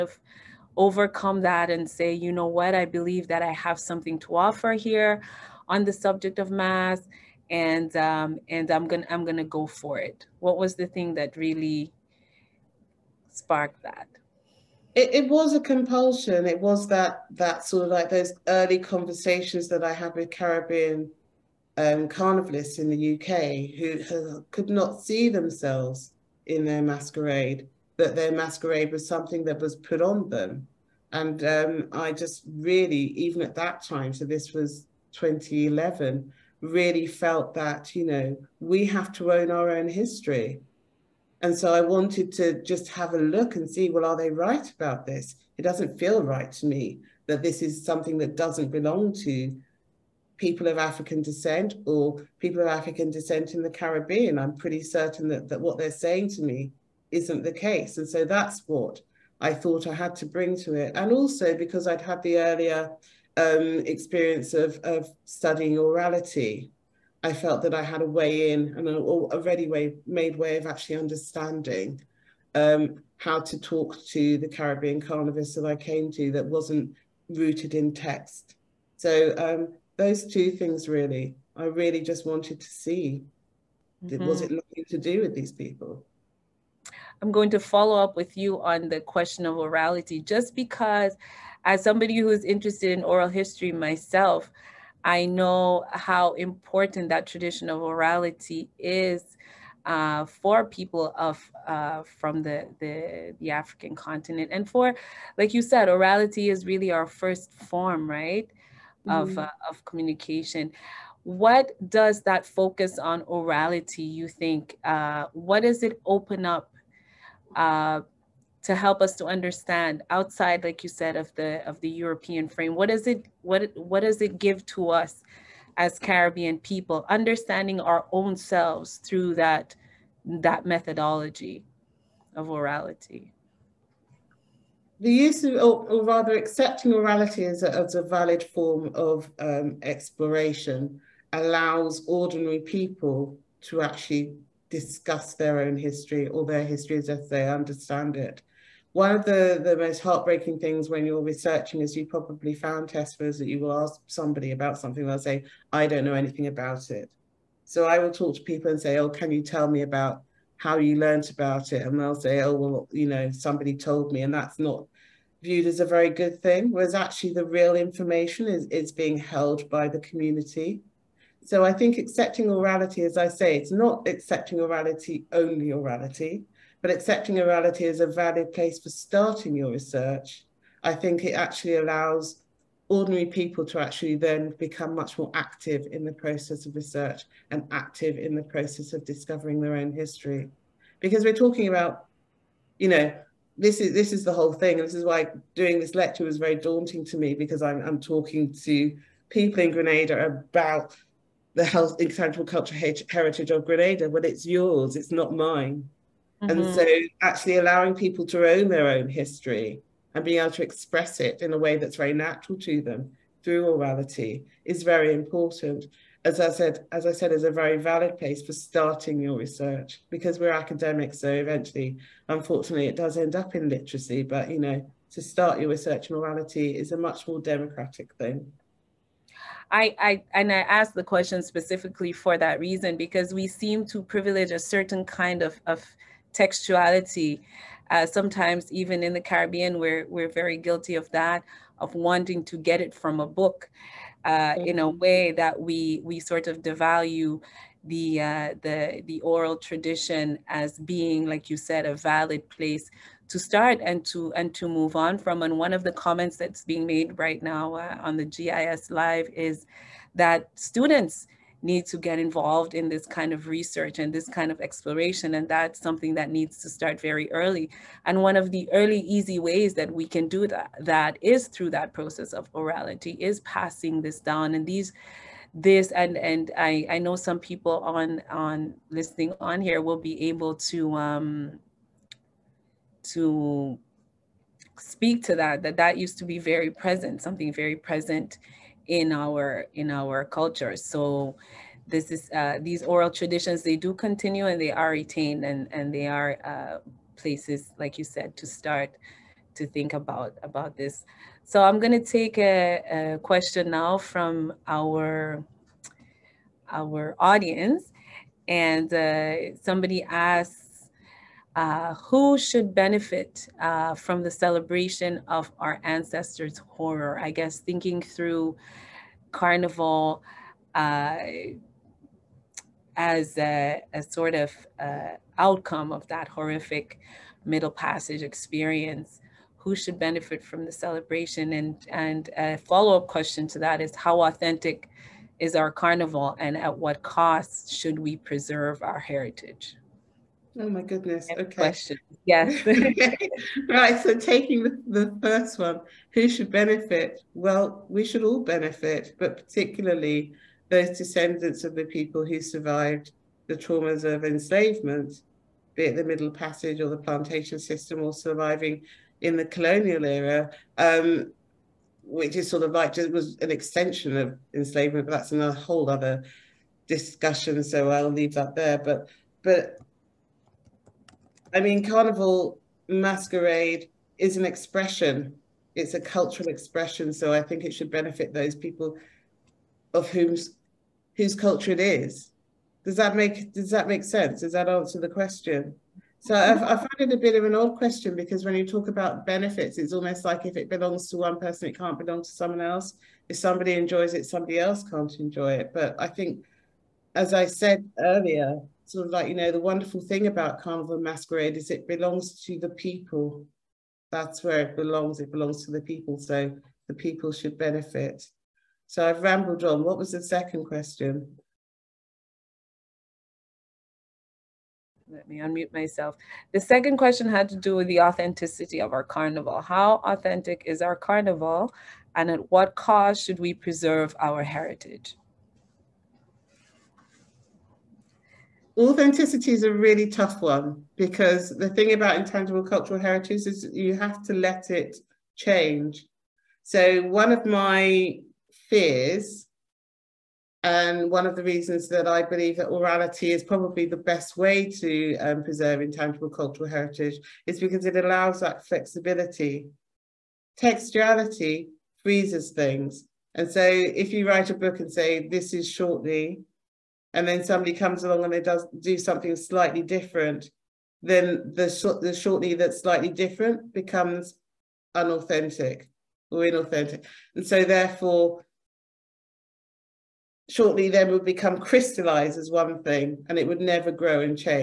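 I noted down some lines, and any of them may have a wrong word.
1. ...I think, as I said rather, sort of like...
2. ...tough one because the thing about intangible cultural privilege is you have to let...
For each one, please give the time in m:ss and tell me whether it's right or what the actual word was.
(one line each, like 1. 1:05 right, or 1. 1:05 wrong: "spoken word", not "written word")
1. 6:35 wrong: "earlier", not "rather"
2. 7:10 wrong: "heritage", not "privilege".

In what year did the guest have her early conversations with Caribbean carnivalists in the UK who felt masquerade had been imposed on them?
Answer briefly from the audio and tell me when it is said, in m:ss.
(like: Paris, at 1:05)
2011, at 0:35.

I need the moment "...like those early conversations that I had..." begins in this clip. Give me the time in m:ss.
0:17.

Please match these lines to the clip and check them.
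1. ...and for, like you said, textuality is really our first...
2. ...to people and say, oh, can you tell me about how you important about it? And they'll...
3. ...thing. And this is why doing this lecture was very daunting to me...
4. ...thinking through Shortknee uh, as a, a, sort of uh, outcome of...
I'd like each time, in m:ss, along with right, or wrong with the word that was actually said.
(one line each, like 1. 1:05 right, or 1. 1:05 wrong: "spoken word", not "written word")
1. 1:44 wrong: "orality", not "textuality"
2. 2:38 wrong: "learnt", not "important"
3. 3:14 right
4. 5:17 wrong: "Carnival", not "Shortknee".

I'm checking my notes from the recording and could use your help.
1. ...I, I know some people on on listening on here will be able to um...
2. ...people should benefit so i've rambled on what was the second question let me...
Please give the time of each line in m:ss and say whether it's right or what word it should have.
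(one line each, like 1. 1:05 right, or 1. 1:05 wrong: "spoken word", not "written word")
1. 4:36 right
2. 6:46 right.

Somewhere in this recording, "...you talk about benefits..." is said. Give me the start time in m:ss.
6:28.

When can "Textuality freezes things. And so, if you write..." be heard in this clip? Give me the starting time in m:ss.
7:30.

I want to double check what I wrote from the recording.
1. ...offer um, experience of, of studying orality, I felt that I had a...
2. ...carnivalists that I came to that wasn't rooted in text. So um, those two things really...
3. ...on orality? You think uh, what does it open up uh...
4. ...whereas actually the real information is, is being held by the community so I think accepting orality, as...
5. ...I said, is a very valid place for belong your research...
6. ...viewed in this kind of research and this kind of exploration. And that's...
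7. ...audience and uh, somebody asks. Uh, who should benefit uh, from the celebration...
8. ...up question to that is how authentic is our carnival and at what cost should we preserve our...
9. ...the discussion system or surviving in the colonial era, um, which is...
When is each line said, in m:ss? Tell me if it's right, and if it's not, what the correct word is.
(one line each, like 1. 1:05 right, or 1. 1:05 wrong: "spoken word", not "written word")
1. 1:02 wrong: "earlier", not "offer"
2. 1:14 right
3. 1:52 right
4. 2:46 right
5. 3:37 wrong: "starting", not "belong"
6. 4:22 wrong: "involved", not "viewed"
7. 5:07 right
8. 5:32 right
9. 5:56 wrong: "plantation", not "discussion".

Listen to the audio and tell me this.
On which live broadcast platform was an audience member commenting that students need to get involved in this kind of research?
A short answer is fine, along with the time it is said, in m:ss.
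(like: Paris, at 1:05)
GIS Live, at 4:18.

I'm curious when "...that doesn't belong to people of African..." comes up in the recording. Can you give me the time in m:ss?
0:48.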